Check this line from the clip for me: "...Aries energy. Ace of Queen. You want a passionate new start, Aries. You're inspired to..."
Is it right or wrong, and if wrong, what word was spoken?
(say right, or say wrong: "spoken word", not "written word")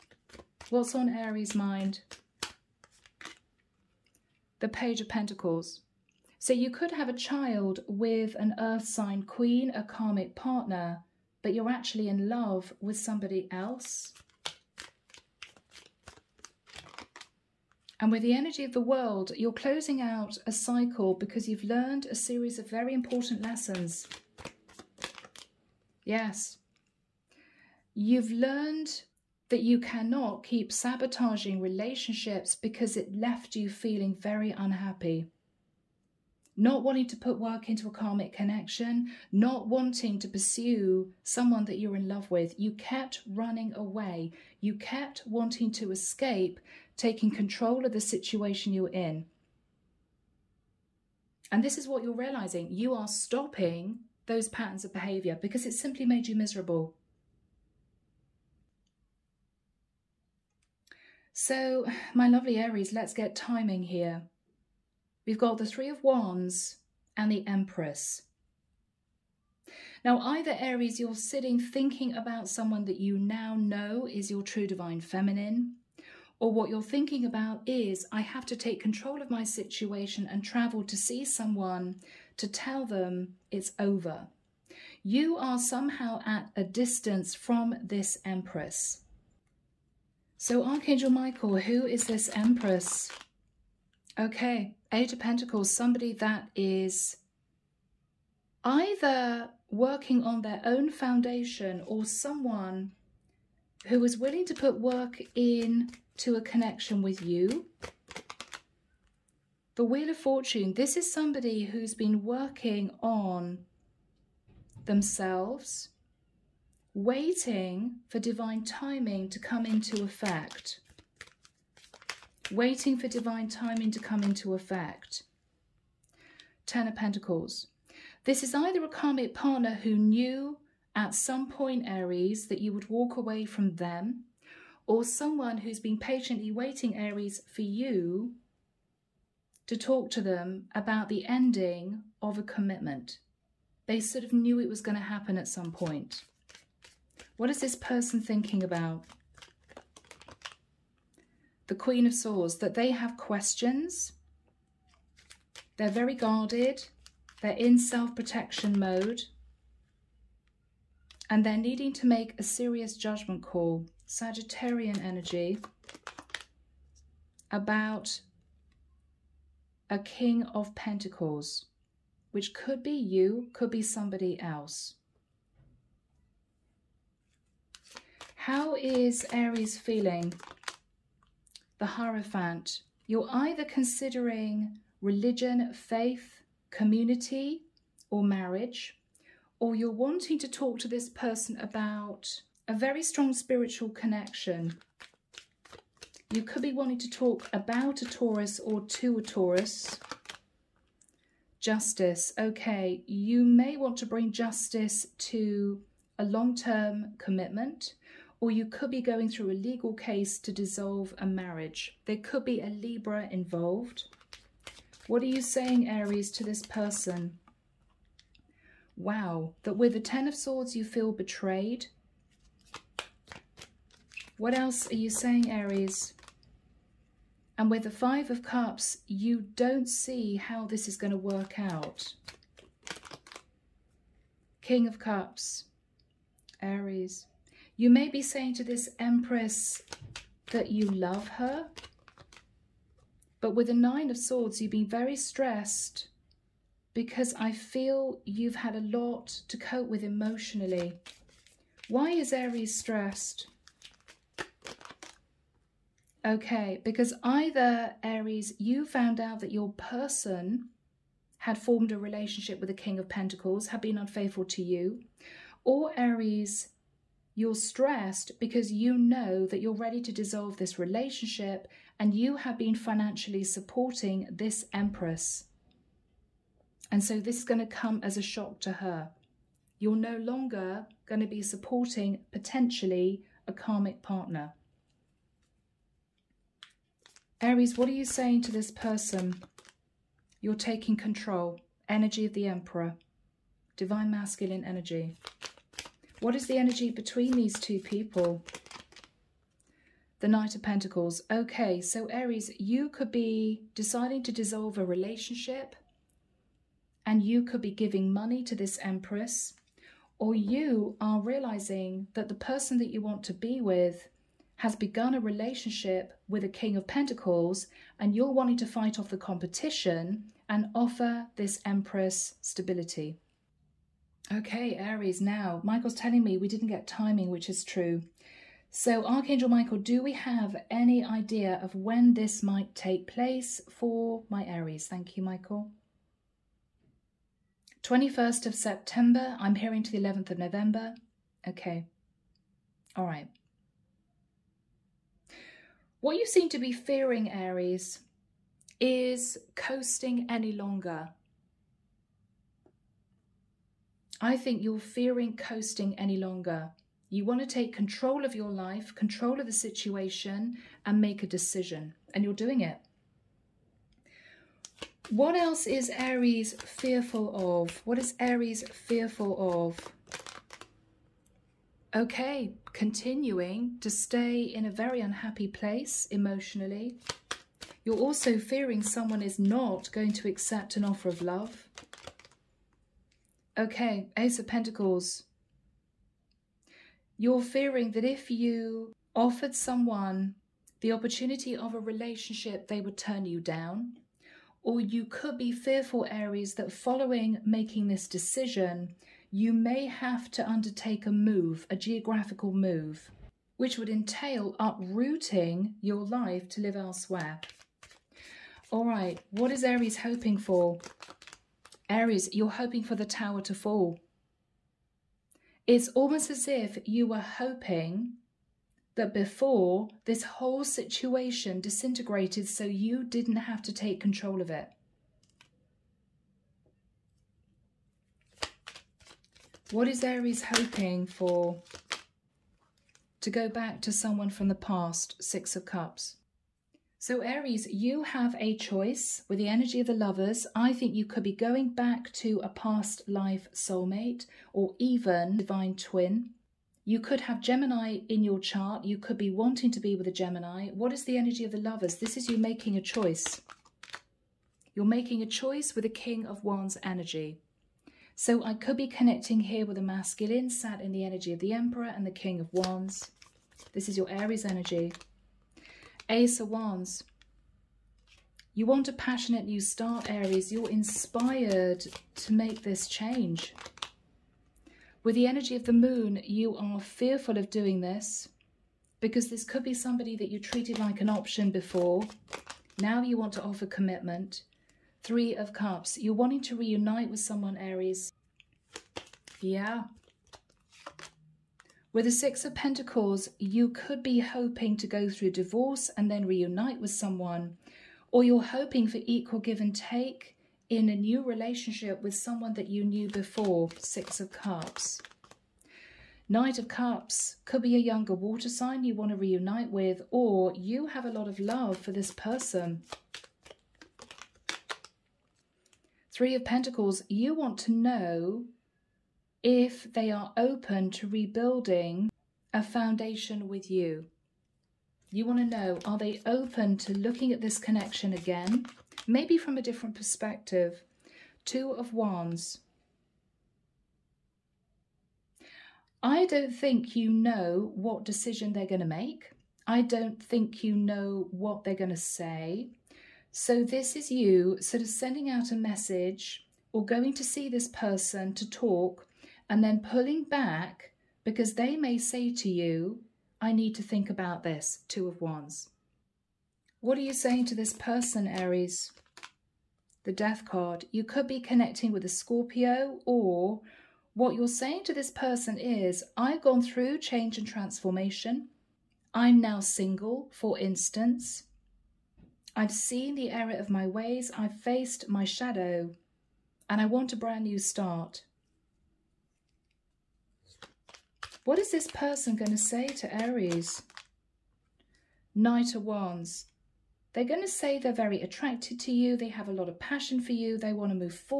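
wrong: "Wands", not "Queen".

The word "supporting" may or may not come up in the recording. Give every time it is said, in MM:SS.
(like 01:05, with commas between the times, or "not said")
04:33, 04:41.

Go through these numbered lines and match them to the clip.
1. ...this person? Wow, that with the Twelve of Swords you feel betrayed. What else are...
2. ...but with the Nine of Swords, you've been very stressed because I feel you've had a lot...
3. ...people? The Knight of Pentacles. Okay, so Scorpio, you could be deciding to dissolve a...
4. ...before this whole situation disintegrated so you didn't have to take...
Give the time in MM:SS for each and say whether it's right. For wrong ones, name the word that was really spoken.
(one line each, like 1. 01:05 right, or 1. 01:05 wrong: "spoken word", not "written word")
1. 03:36 wrong: "Ten", not "Twelve"
2. 04:03 right
3. 04:57 wrong: "Aries", not "Scorpio"
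4. 06:59 right.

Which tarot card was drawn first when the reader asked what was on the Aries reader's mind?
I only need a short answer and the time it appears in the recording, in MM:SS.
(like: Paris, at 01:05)
Page of Pentacles, at 00:04.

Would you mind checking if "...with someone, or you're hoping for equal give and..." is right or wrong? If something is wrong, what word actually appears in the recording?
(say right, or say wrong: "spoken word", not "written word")
right.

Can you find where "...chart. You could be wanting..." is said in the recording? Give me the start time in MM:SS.
07:28.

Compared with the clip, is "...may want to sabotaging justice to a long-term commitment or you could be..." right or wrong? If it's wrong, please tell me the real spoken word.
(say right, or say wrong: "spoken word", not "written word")
wrong: "bring", not "sabotaging".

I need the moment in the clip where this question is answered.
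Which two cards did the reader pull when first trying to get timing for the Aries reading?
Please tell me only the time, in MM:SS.
01:05.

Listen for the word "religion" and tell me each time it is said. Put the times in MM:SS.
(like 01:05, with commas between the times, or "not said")
03:04.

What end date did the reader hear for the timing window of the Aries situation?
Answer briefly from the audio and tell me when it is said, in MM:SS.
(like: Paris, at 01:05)
11 November, at 05:39.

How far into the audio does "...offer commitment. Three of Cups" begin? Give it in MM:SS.
08:03.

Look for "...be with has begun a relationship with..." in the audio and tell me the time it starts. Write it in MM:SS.
05:13.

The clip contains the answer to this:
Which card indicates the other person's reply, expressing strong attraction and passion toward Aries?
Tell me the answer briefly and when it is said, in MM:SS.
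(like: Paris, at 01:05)
Knight of Wands, at 09:45.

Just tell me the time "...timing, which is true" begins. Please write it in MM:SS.
05:26.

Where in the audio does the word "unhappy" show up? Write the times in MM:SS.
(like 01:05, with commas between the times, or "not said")
00:34, 06:15.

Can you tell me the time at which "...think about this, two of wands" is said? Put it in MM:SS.
09:13.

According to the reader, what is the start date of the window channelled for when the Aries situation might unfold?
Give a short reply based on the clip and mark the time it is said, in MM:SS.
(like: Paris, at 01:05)
21 September, at 05:37.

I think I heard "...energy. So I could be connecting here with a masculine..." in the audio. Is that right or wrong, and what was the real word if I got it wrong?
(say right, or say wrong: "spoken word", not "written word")
right.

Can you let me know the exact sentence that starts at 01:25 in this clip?
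You are somehow at a distance from this Empress.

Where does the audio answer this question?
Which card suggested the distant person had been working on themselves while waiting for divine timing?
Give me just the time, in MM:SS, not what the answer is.
01:49.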